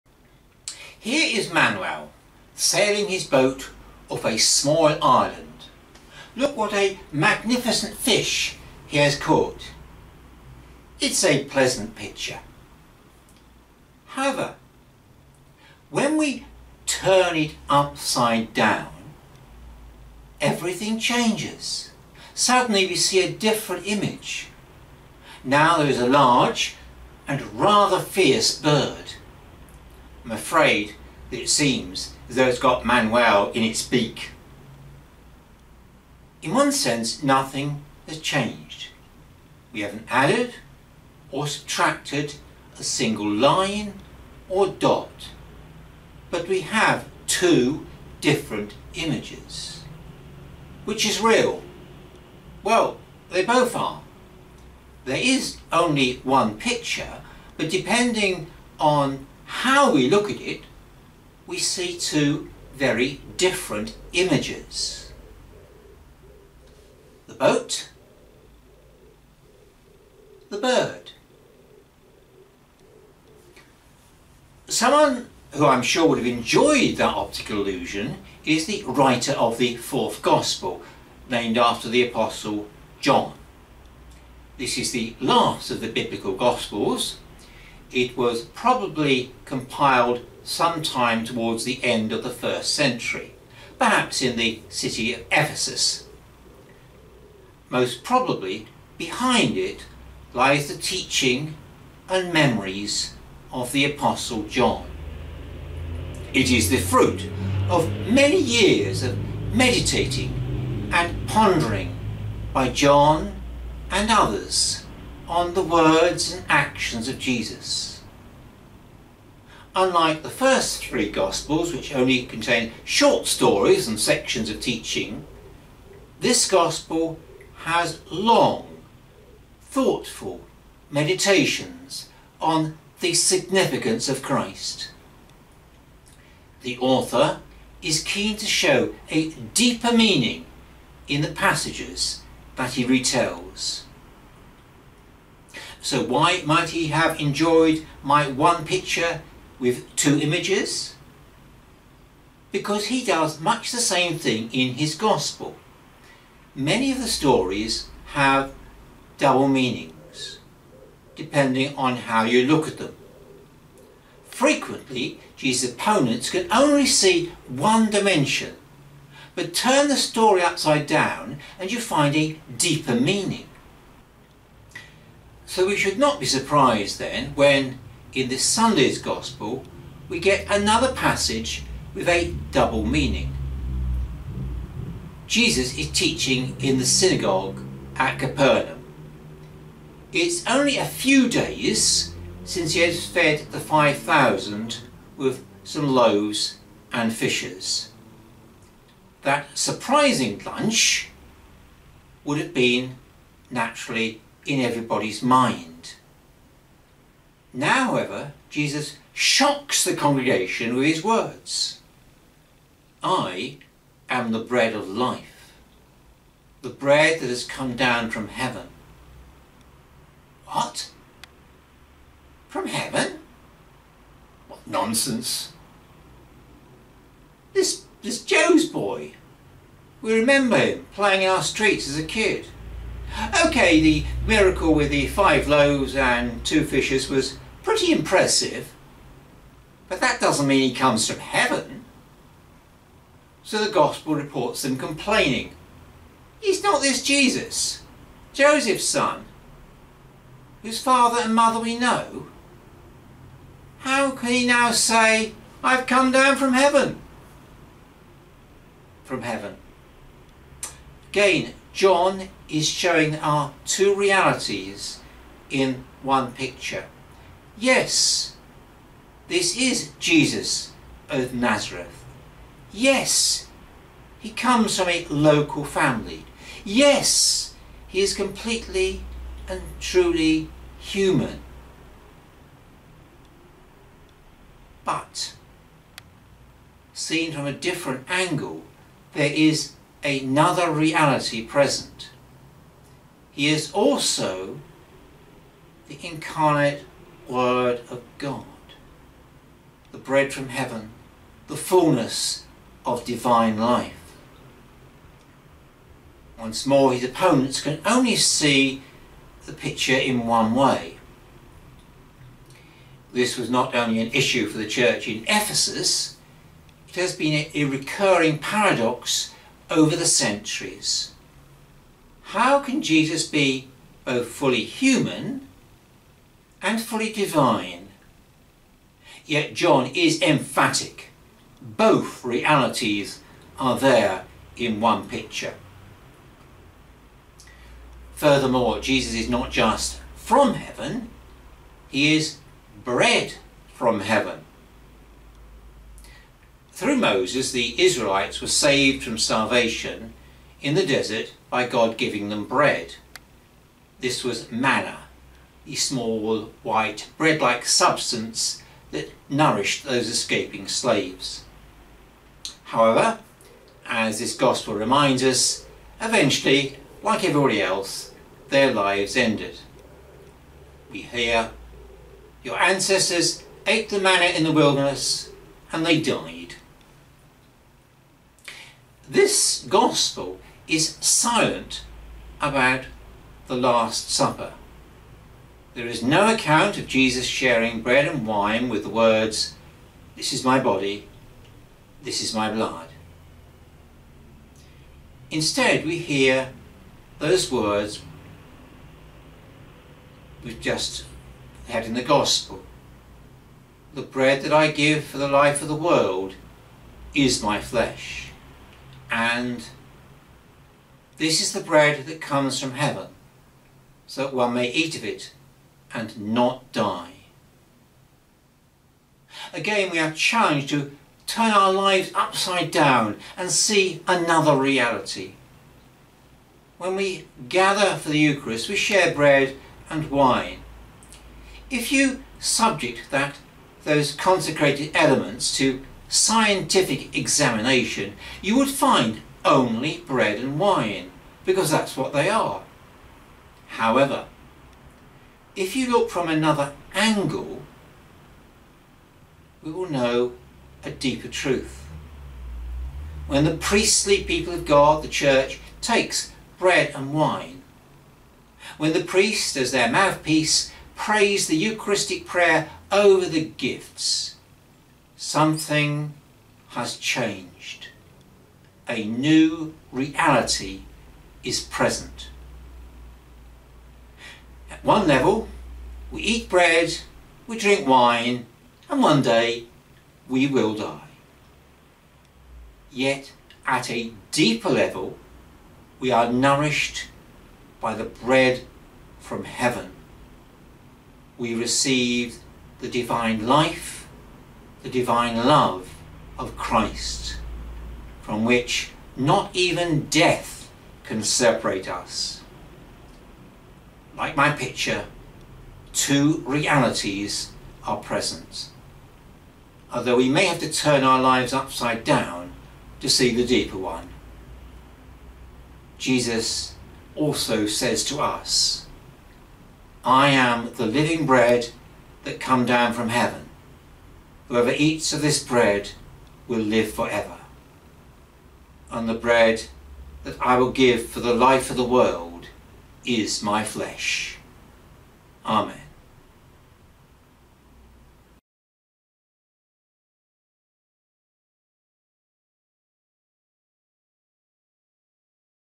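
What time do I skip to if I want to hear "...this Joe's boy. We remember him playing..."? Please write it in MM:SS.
03:48.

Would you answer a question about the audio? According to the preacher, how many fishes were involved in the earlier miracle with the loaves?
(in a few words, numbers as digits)
2.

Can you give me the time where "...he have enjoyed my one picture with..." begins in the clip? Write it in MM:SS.
02:26.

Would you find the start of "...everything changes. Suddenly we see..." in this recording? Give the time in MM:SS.
00:20.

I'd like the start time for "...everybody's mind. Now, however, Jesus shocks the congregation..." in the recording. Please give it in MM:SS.
03:24.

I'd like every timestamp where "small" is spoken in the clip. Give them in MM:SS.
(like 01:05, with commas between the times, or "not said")
00:04, 05:55.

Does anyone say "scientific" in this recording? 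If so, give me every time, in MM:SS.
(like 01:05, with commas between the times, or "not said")
07:16.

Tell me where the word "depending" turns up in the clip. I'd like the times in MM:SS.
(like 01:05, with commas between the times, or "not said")
00:57, 02:41.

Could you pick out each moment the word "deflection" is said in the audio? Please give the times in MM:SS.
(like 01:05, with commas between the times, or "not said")
not said.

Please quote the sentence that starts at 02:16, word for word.
The author is keen to show a deeper meaning in the passages that he retells.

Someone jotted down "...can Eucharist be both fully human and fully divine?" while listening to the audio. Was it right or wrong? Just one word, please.
wrong.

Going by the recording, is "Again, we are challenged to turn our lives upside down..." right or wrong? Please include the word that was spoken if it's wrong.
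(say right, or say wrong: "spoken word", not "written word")
right.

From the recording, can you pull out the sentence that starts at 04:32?
Yes, he comes from a local family.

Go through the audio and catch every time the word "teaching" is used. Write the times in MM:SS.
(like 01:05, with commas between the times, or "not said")
01:40, 02:04, 03:05.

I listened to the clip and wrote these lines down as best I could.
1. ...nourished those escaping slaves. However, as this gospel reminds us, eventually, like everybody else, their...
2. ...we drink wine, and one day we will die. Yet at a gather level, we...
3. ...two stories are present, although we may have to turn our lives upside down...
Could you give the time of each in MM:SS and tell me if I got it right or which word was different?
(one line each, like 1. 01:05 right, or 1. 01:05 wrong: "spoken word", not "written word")
1. 05:59 right
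2. 07:57 wrong: "deeper", not "gather"
3. 08:25 wrong: "realities", not "stories".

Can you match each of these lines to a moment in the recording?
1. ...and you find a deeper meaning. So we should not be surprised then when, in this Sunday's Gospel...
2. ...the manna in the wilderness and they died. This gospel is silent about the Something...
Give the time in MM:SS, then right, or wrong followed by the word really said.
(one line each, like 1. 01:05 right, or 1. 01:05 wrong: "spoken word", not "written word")
1. 02:51 right
2. 06:13 wrong: "Last", not "Something".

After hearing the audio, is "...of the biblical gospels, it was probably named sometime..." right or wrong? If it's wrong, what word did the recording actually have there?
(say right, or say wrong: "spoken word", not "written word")
wrong: "compiled", not "named".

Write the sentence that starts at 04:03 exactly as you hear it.
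So the Gospel reports them complaining.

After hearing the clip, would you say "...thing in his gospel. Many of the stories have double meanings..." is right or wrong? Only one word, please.
right.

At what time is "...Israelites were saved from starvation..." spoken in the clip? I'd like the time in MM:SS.
05:47.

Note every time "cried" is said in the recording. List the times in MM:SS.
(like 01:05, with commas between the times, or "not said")
not said.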